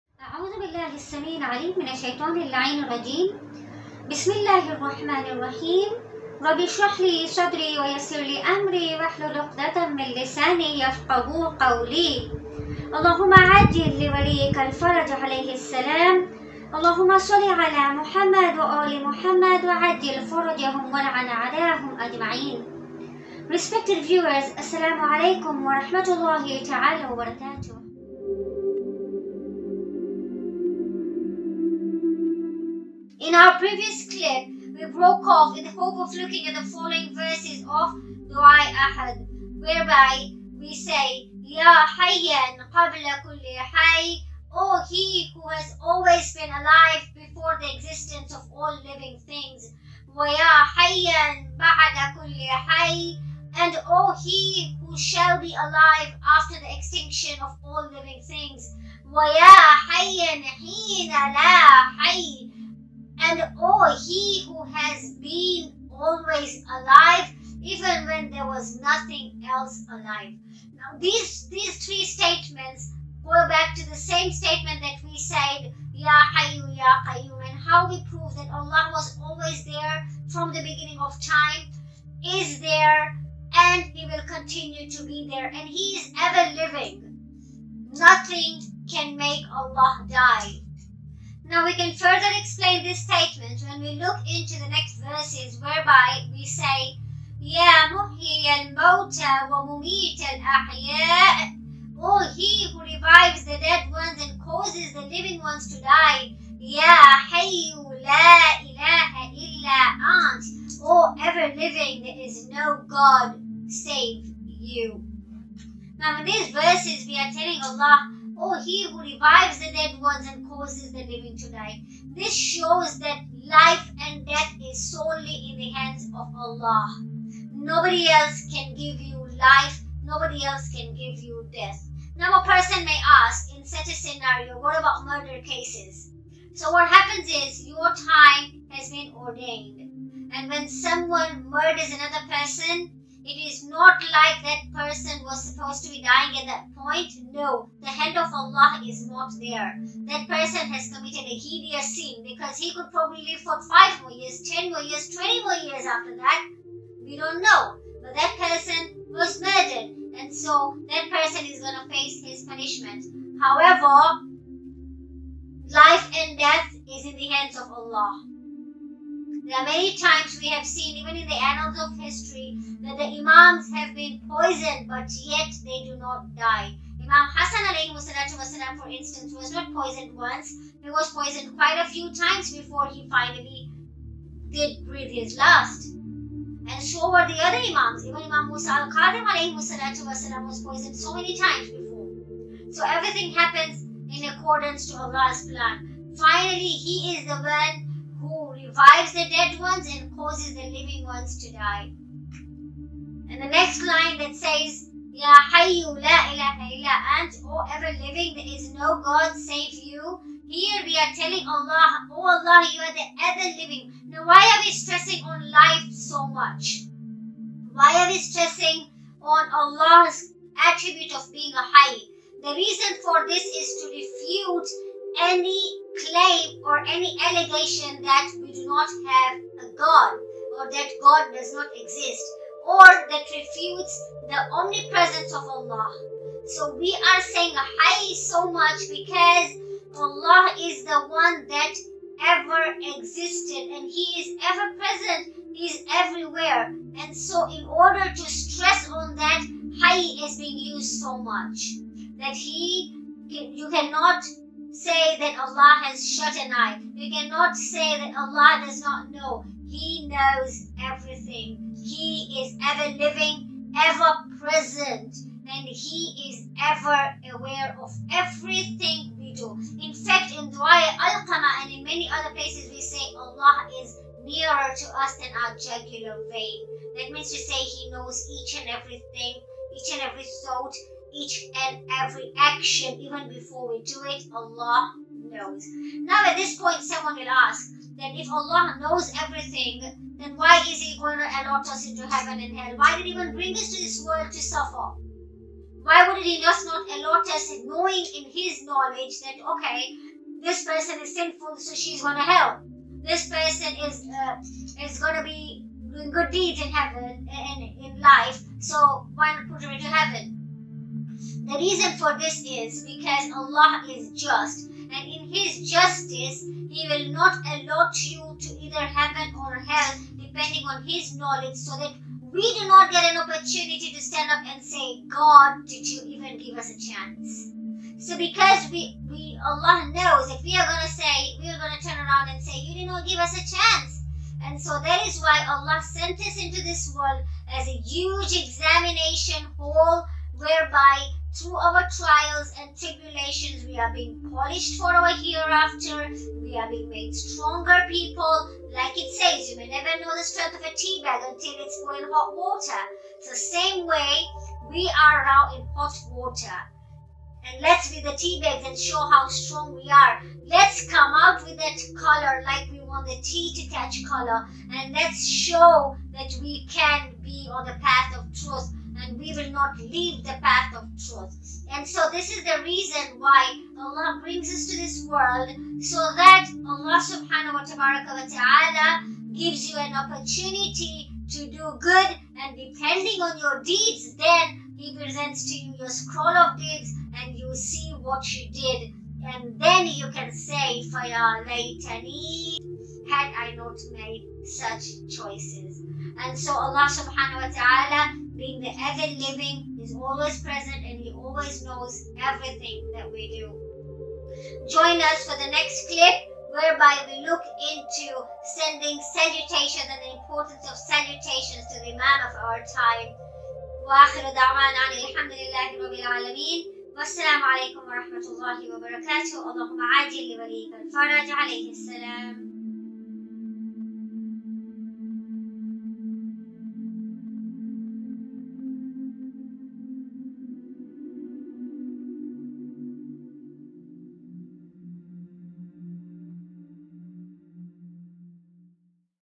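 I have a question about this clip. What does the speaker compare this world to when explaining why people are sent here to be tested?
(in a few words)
a huge examination hall.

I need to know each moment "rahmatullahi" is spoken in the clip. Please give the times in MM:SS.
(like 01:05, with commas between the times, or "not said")
00:25.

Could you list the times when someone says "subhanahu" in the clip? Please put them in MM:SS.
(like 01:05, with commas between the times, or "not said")
06:17, 06:36.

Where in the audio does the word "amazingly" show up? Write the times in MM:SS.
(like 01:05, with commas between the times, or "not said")
not said.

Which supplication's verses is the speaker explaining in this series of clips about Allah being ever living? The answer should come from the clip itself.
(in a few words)
Dua Ahad.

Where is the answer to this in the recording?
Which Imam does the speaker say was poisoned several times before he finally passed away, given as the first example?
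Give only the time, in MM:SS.
02:57.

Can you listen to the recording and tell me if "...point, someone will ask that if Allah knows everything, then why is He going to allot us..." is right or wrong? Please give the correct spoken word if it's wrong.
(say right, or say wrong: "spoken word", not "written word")
right.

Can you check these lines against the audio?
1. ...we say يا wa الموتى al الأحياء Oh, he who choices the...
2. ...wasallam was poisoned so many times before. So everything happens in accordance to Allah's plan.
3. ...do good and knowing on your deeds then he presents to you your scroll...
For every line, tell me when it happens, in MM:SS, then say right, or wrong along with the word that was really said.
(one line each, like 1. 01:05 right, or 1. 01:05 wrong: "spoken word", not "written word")
1. 01:36 wrong: "revives", not "choices"
2. 03:09 right
3. 06:21 wrong: "depending", not "knowing".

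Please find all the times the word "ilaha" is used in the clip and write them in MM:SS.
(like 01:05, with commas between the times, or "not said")
01:48, 03:26.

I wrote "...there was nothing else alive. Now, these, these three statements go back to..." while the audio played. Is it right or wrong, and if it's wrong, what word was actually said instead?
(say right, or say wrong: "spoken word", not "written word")
right.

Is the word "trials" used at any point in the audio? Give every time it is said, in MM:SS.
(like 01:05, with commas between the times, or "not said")
05:41.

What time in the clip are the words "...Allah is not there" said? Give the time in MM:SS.
02:28.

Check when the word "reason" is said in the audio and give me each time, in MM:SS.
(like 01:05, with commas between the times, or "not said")
03:42, 05:11, 06:12.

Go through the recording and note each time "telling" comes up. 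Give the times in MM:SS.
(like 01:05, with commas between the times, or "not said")
01:57, 03:31.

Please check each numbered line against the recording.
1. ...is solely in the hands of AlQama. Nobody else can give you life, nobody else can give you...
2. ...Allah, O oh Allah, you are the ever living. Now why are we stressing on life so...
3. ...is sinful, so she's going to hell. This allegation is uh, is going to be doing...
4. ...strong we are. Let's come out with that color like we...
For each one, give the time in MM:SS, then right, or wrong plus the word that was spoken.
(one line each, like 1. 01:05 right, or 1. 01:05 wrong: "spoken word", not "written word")
1. 02:04 wrong: "Allah", not "AlQama"
2. 03:31 right
3. 05:01 wrong: "person", not "allegation"
4. 05:59 right.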